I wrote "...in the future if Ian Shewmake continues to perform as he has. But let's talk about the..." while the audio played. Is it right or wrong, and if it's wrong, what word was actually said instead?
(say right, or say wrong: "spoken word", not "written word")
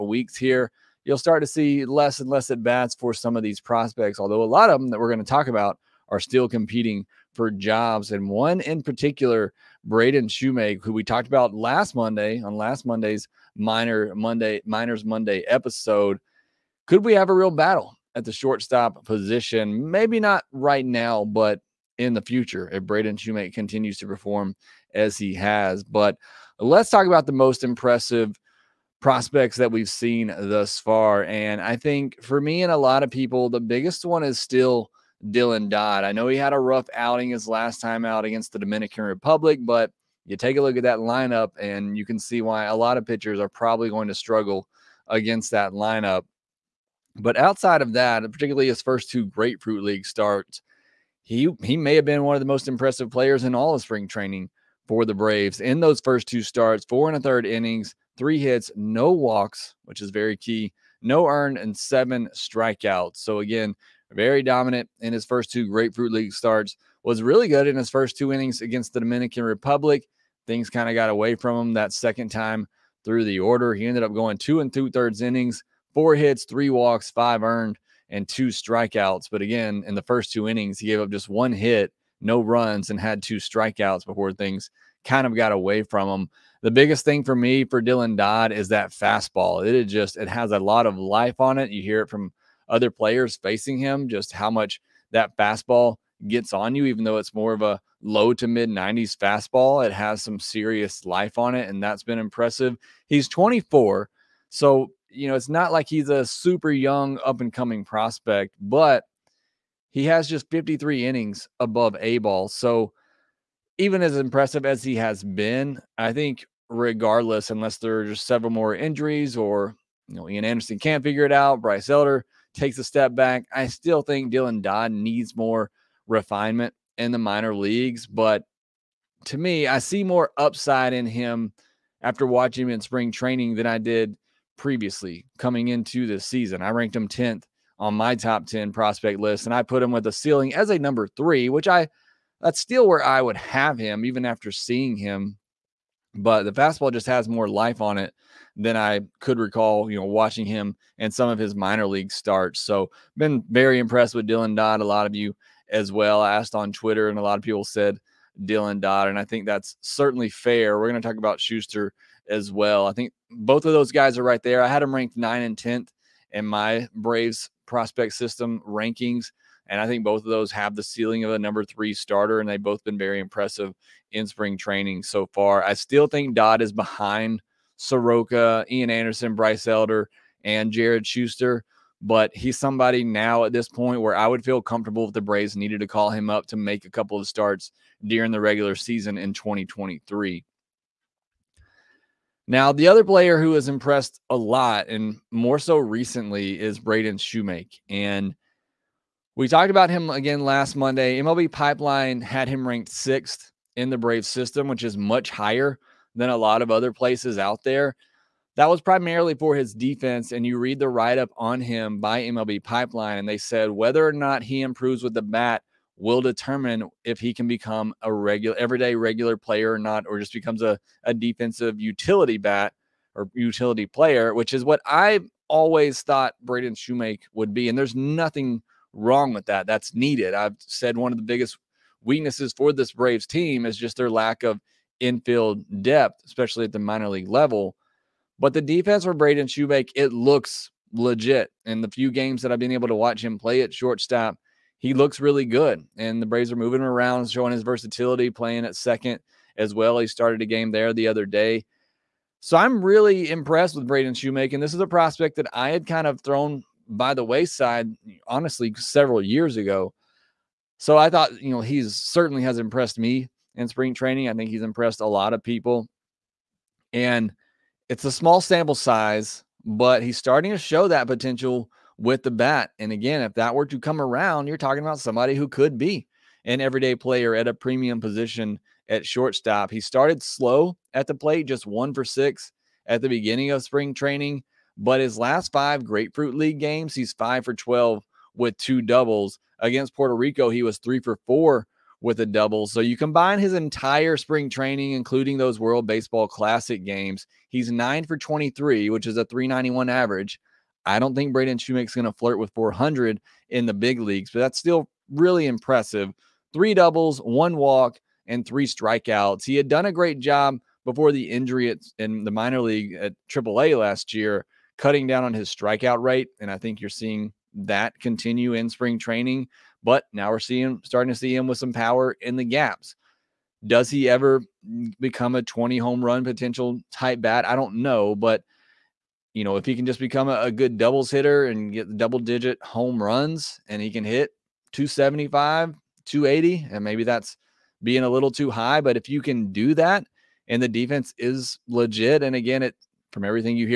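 wrong: "Braden", not "Ian".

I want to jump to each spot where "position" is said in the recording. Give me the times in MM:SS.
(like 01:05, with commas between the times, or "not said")
00:19, 04:38.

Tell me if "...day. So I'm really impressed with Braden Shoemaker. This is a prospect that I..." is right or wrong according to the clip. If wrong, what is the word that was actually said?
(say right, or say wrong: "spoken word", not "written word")
right.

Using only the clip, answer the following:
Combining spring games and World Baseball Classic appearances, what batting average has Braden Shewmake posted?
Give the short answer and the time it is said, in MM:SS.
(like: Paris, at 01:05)
.391, at 04:59.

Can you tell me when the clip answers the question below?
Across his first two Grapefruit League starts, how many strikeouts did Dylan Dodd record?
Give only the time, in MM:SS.
01:01.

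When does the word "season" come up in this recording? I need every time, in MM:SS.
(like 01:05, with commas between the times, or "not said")
02:16, 03:08.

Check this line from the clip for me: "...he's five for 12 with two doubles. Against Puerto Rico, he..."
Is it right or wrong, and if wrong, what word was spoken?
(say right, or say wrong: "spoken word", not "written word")
right.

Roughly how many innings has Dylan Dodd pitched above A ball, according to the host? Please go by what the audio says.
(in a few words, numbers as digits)
53.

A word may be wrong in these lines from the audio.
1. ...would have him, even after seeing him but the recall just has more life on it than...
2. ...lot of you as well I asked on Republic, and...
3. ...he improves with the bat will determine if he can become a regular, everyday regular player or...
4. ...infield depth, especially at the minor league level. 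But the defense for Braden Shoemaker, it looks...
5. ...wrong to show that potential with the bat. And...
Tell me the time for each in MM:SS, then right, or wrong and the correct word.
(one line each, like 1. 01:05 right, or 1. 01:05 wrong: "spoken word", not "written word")
1. 02:23 wrong: "fastball", not "recall"
2. 02:34 wrong: "Twitter", not "Republic"
3. 03:34 right
4. 03:54 right
5. 04:30 wrong: "starting", not "wrong".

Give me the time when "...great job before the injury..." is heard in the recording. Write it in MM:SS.
05:09.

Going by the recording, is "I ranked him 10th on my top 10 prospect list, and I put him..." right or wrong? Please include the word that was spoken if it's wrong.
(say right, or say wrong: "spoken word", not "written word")
right.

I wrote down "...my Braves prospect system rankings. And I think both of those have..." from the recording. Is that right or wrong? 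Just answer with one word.
right.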